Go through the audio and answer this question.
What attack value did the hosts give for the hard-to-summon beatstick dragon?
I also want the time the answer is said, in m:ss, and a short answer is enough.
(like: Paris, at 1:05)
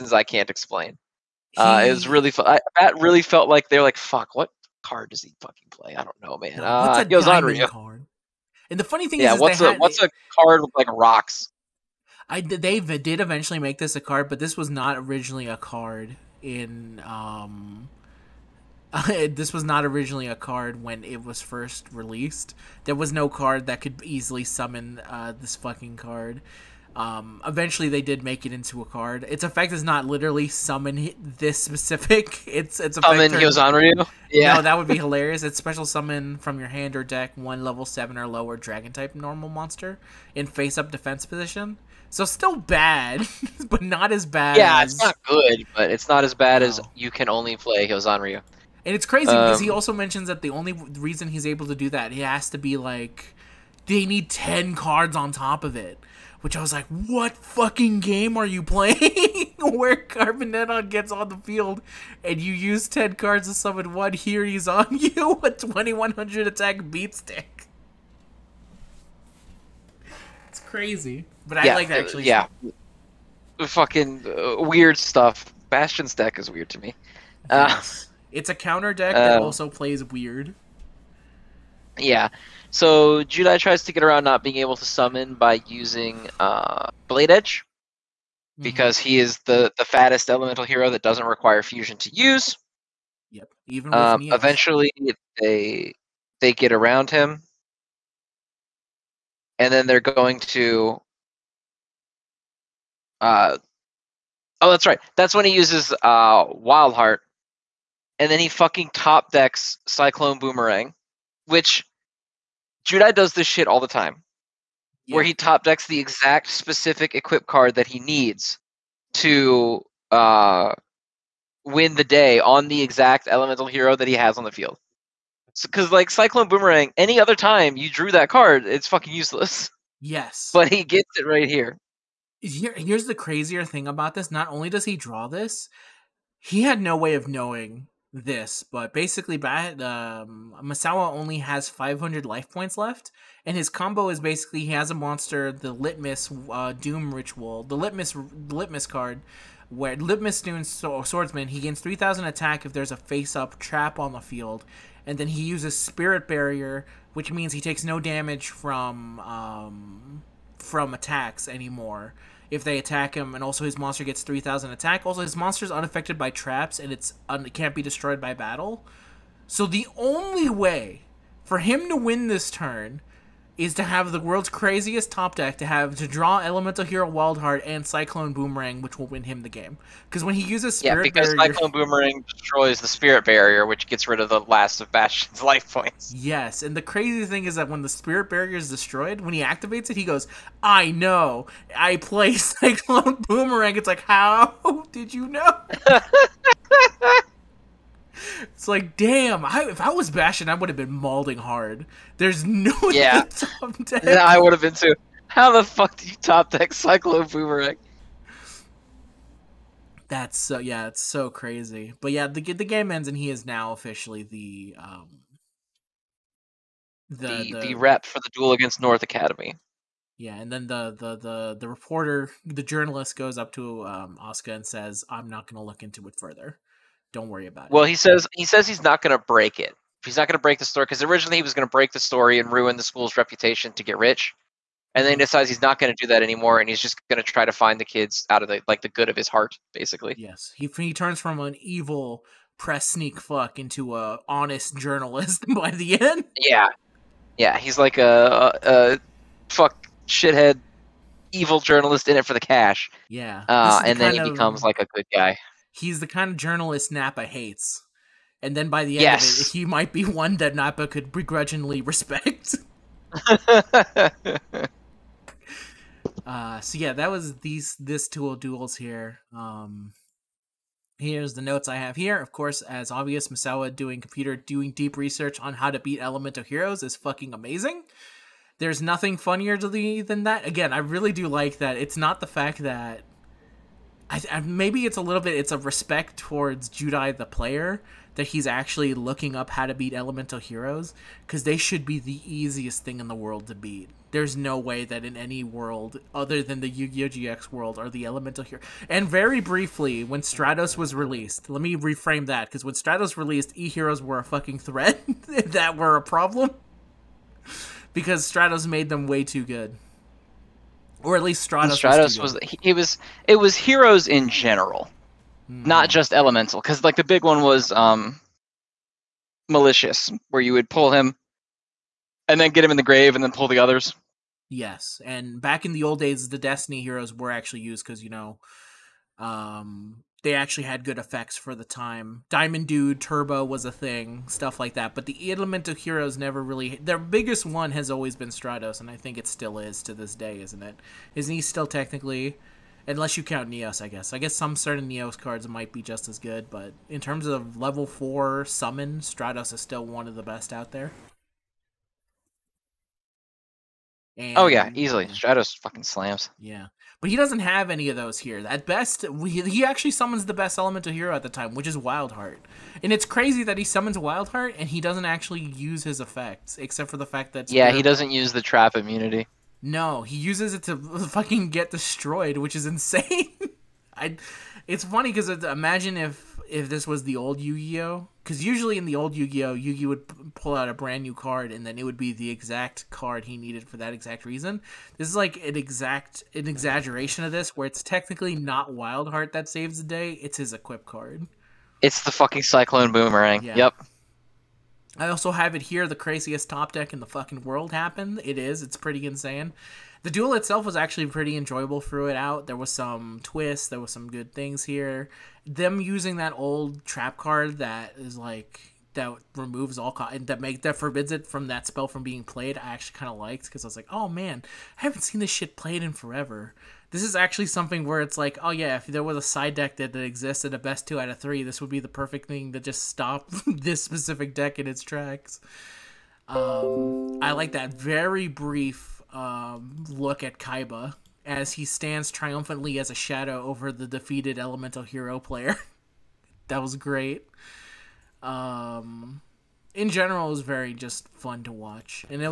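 2100, at 1:05.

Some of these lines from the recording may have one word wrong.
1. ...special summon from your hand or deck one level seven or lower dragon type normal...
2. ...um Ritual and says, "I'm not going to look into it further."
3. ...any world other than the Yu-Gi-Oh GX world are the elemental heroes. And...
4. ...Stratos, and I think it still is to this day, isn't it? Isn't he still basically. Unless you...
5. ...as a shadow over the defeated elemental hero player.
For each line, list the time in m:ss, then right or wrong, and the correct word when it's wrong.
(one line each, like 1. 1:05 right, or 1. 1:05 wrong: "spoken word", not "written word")
1. 0:35 right
2. 3:43 wrong: "Oscar", not "Ritual"
3. 4:55 right
4. 5:38 wrong: "technically", not "basically"
5. 7:12 right.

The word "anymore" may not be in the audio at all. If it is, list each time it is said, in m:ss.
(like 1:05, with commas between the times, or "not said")
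2:41, 3:56.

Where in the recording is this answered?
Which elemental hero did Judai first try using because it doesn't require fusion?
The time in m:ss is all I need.
1:27.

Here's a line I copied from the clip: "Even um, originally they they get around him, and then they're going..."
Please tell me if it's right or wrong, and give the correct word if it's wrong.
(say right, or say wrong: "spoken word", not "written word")
wrong: "eventually", not "originally".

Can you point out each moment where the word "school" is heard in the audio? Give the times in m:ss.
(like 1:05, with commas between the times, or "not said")
3:52.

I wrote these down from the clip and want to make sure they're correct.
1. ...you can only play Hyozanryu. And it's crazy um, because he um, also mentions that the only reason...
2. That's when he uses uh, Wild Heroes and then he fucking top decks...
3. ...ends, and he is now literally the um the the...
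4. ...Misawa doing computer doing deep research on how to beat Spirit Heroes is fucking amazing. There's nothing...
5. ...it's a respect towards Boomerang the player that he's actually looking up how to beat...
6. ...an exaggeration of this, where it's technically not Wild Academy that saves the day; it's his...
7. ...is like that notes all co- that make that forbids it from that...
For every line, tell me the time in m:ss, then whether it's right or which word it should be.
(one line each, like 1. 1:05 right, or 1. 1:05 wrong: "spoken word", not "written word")
1. 0:46 right
2. 1:45 wrong: "Heart", not "Heroes"
3. 3:32 wrong: "officially", not "literally"
4. 4:33 wrong: "Elemental", not "Spirit"
5. 4:45 wrong: "Judai", not "Boomerang"
6. 6:26 wrong: "Heart", not "Academy"
7. 6:47 wrong: "removes", not "notes".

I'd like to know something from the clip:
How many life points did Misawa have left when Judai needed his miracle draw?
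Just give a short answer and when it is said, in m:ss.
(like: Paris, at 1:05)
500, at 2:21.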